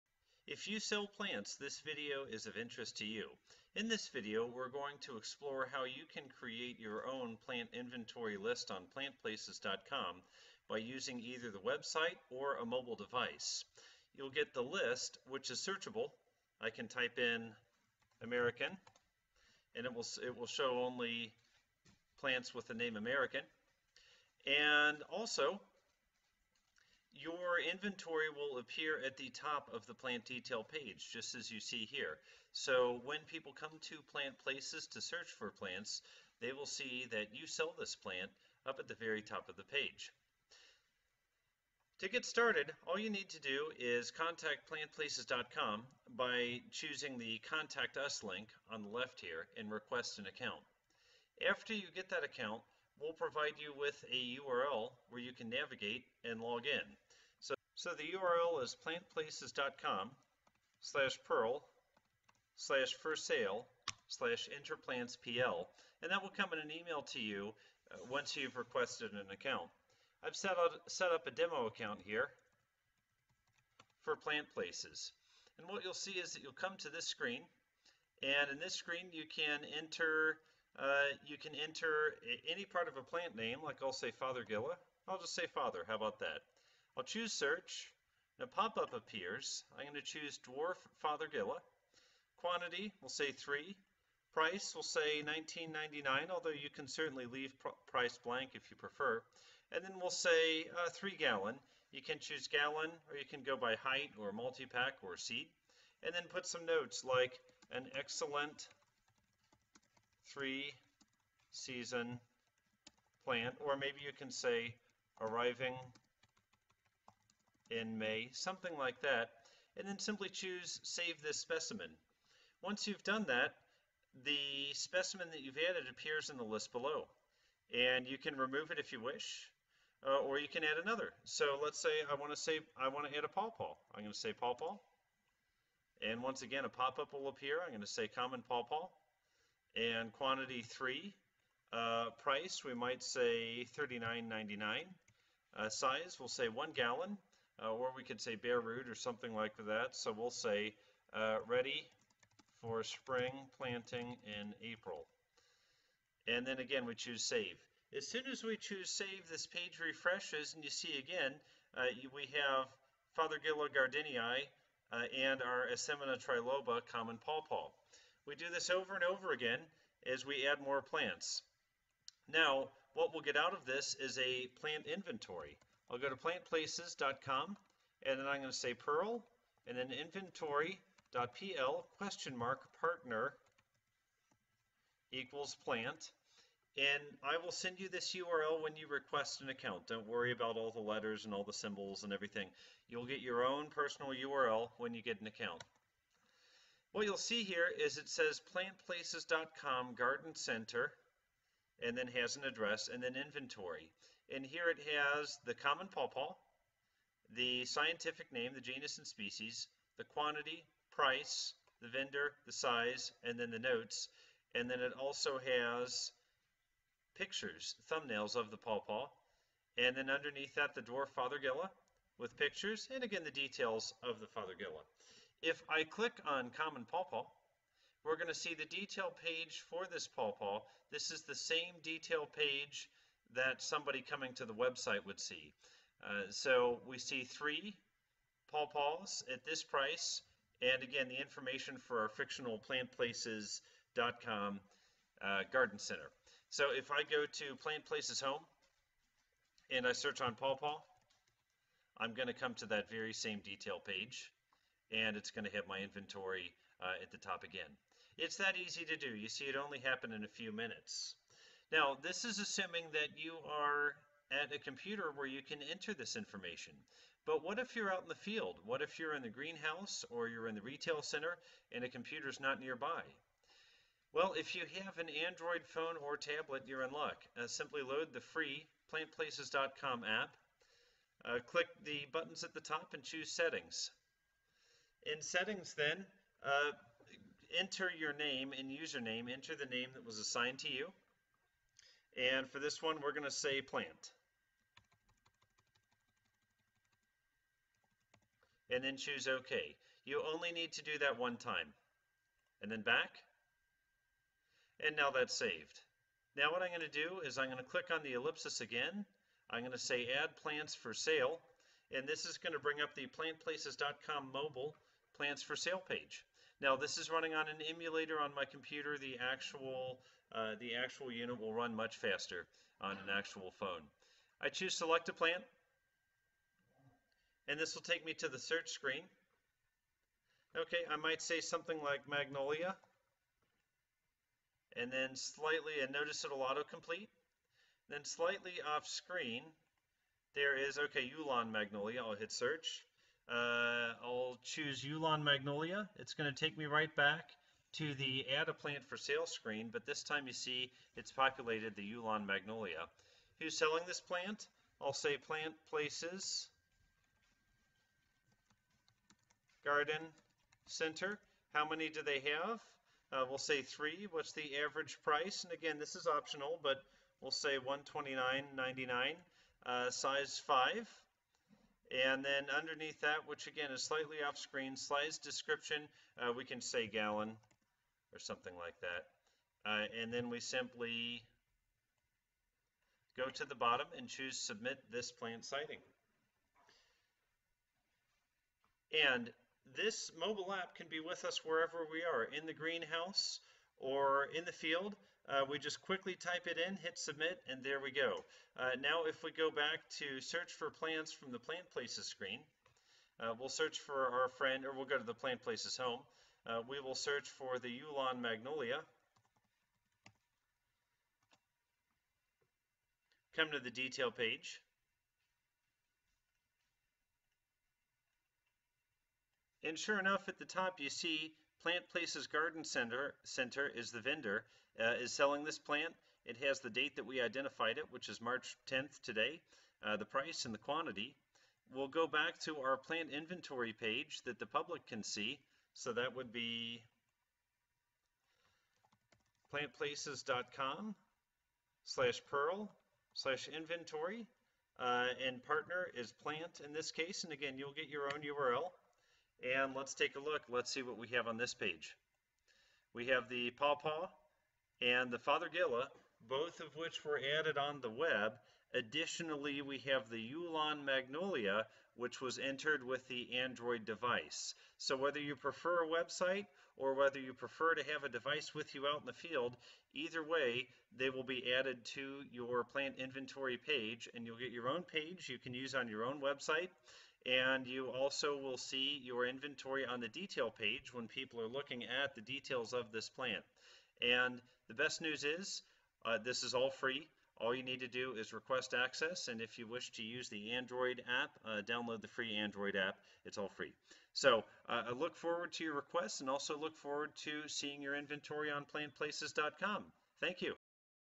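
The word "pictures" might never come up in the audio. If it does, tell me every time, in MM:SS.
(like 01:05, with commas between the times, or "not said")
03:37, 03:42.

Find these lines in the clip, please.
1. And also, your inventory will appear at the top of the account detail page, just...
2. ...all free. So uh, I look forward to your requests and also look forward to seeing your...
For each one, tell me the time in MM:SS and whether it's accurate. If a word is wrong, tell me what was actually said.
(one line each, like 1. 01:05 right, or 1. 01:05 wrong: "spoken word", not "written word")
1. 00:24 wrong: "plant", not "account"
2. 08:13 right.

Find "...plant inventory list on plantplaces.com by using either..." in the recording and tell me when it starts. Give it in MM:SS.
00:07.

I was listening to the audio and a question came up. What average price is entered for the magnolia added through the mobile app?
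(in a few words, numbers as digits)
129.99.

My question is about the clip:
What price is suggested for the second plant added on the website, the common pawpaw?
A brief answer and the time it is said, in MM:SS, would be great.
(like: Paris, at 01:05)
39.99, at 02:23.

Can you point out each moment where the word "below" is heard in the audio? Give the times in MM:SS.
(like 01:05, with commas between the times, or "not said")
02:06.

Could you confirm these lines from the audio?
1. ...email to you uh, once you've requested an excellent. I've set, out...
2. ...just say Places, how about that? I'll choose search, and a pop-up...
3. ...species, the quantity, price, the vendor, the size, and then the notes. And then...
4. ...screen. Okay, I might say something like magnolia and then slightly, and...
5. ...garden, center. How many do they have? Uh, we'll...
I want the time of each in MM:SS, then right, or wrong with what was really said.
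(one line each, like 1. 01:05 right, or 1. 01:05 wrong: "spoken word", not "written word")
1. 01:06 wrong: "account", not "excellent"
2. 01:25 wrong: "Father", not "Places"
3. 03:29 right
4. 05:28 right
5. 05:59 right.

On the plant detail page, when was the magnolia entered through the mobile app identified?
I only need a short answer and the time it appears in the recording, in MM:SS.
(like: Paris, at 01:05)
March 10th, at 07:08.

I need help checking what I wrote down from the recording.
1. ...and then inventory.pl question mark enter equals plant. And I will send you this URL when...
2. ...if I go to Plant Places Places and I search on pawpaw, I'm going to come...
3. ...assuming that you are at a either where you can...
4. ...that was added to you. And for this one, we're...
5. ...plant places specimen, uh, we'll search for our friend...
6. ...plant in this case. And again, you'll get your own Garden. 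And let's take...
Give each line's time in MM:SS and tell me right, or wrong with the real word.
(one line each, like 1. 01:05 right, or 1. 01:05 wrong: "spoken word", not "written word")
1. 02:59 wrong: "partner", not "enter"
2. 04:06 wrong: "Home", not "Places"
3. 04:22 wrong: "computer", not "either"
4. 04:49 wrong: "assigned", not "added"
5. 06:41 wrong: "screen", not "specimen"
6. 07:26 wrong: "URL", not "Garden".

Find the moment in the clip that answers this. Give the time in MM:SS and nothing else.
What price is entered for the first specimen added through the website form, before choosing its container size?
01:35.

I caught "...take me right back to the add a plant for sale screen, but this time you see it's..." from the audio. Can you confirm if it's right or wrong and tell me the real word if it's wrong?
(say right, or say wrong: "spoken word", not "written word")
right.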